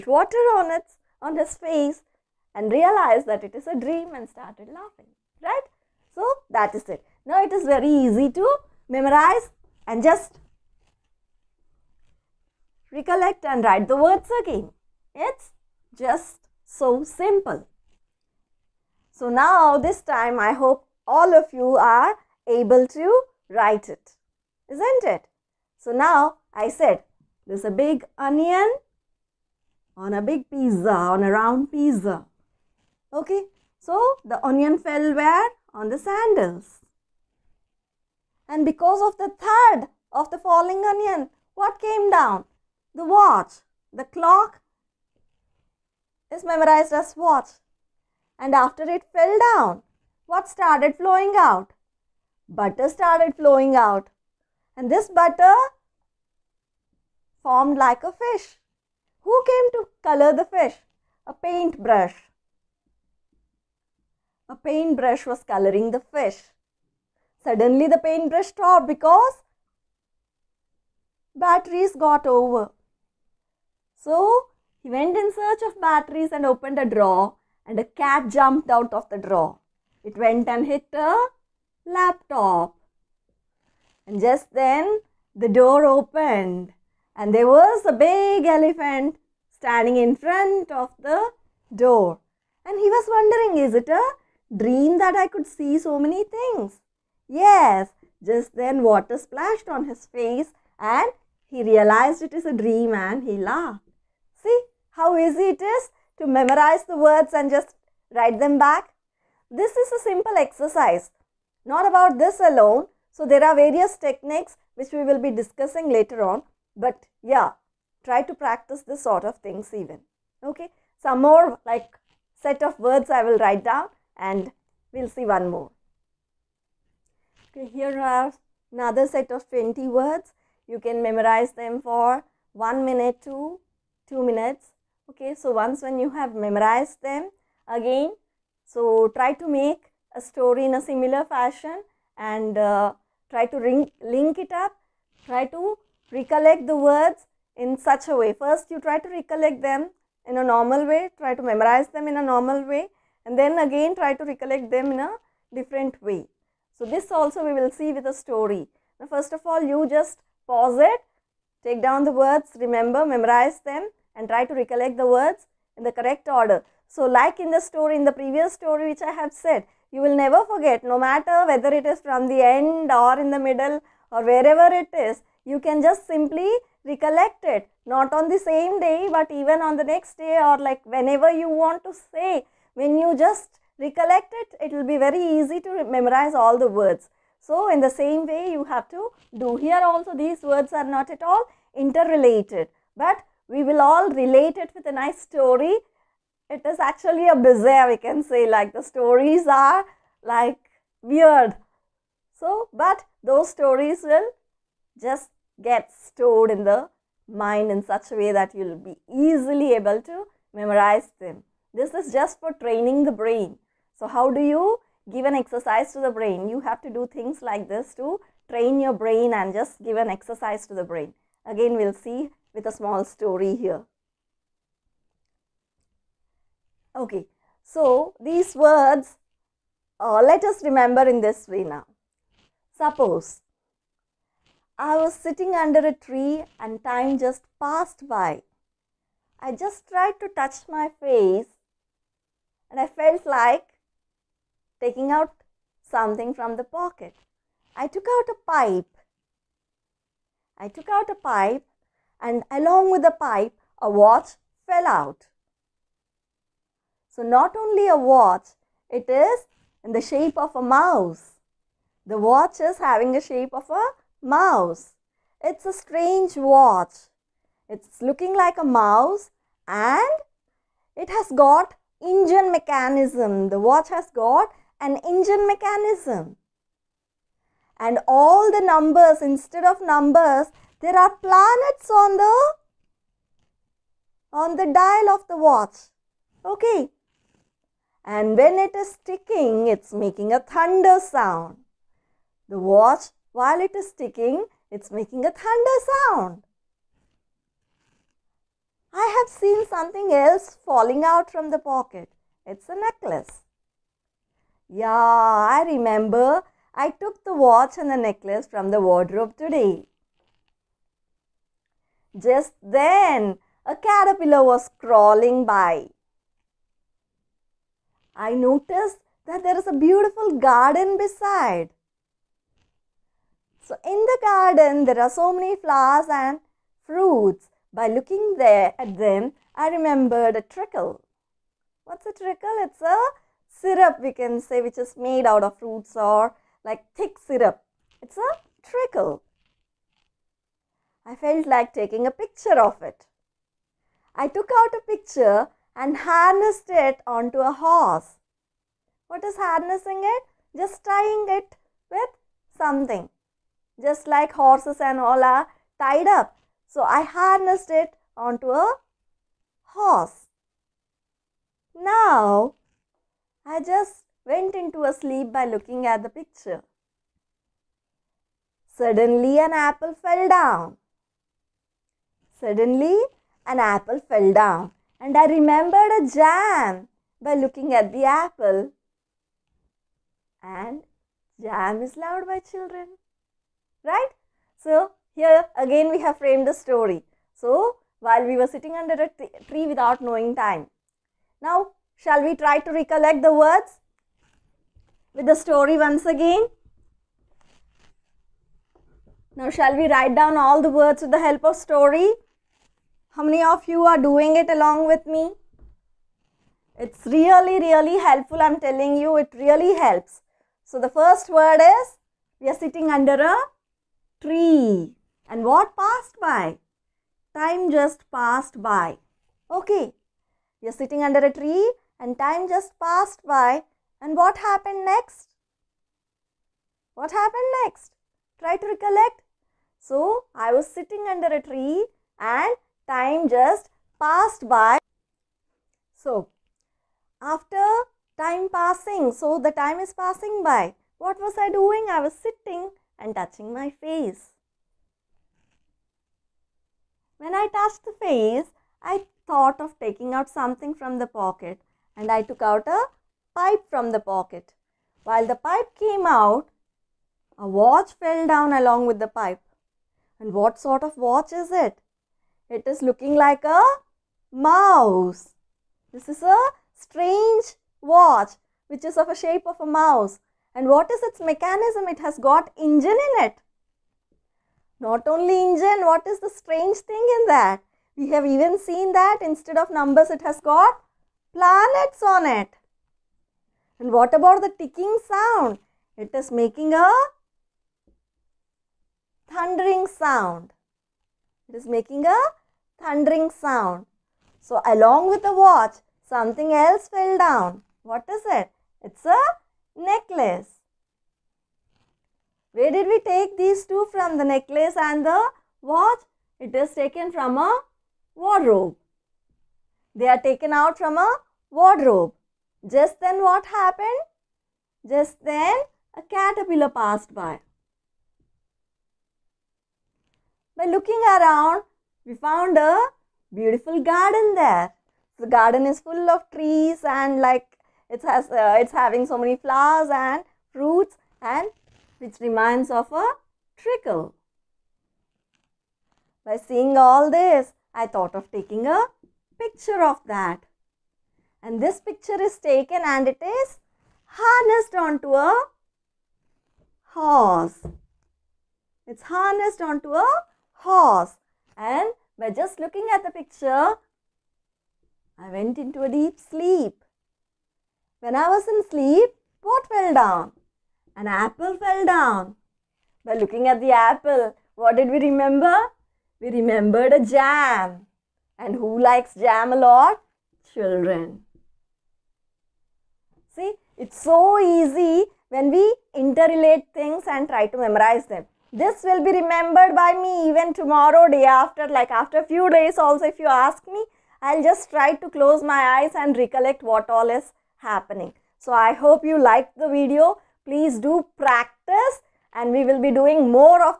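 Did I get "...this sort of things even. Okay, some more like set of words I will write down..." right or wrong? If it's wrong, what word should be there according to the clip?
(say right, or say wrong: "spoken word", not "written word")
right.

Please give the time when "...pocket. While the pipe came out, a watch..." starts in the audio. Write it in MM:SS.
07:33.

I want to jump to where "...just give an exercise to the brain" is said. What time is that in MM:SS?
03:39.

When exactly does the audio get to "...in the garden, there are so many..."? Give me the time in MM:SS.
05:23.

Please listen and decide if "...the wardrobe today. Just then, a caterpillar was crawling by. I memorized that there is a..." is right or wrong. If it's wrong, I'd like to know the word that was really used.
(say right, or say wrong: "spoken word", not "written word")
wrong: "noticed", not "memorized".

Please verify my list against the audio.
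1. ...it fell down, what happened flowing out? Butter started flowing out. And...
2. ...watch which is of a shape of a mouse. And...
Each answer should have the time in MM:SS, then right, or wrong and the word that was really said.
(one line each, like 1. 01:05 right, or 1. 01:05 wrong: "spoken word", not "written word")
1. 00:48 wrong: "started", not "happened"
2. 07:47 right.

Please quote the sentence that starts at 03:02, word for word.
When you just recollect it, it will be very easy to memorize all the words.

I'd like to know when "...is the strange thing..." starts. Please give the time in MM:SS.
07:56.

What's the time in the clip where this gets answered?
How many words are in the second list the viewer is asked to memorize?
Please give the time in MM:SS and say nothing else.
02:09.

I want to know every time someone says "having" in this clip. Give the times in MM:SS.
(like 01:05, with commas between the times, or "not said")
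04:22, 08:48.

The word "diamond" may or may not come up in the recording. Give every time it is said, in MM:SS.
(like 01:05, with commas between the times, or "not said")
not said.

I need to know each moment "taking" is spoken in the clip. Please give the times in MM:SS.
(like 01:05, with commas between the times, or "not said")
04:04, 05:41, 07:29, 08:58.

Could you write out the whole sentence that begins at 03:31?
This is just for training the brain.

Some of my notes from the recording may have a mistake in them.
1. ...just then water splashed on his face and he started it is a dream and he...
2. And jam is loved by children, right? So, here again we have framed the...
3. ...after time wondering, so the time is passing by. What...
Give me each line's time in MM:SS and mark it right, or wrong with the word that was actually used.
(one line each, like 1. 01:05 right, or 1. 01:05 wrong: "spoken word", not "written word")
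1. 01:38 wrong: "realized", not "started"
2. 06:20 right
3. 07:17 wrong: "passing", not "wondering".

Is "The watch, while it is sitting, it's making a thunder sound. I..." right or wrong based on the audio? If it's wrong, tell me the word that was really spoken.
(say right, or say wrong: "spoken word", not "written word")
wrong: "ticking", not "sitting".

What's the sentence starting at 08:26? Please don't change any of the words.
It is taken from a wardrobe.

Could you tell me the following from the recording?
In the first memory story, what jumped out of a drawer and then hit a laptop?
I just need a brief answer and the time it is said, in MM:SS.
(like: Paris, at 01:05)
A cat, at 01:17.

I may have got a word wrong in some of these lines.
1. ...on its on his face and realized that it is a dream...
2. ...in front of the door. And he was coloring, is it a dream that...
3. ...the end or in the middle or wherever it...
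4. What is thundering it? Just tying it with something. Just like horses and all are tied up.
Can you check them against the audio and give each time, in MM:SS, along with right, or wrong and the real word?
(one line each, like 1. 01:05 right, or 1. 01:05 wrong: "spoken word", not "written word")
1. 00:00 right
2. 01:29 wrong: "wondering", not "coloring"
3. 02:52 right
4. 05:49 wrong: "harnessing", not "thundering".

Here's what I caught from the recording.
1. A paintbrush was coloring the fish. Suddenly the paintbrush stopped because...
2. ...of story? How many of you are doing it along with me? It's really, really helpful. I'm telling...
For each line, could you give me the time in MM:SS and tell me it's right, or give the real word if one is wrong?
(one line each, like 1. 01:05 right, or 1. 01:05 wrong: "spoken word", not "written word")
1. 01:04 right
2. 06:41 right.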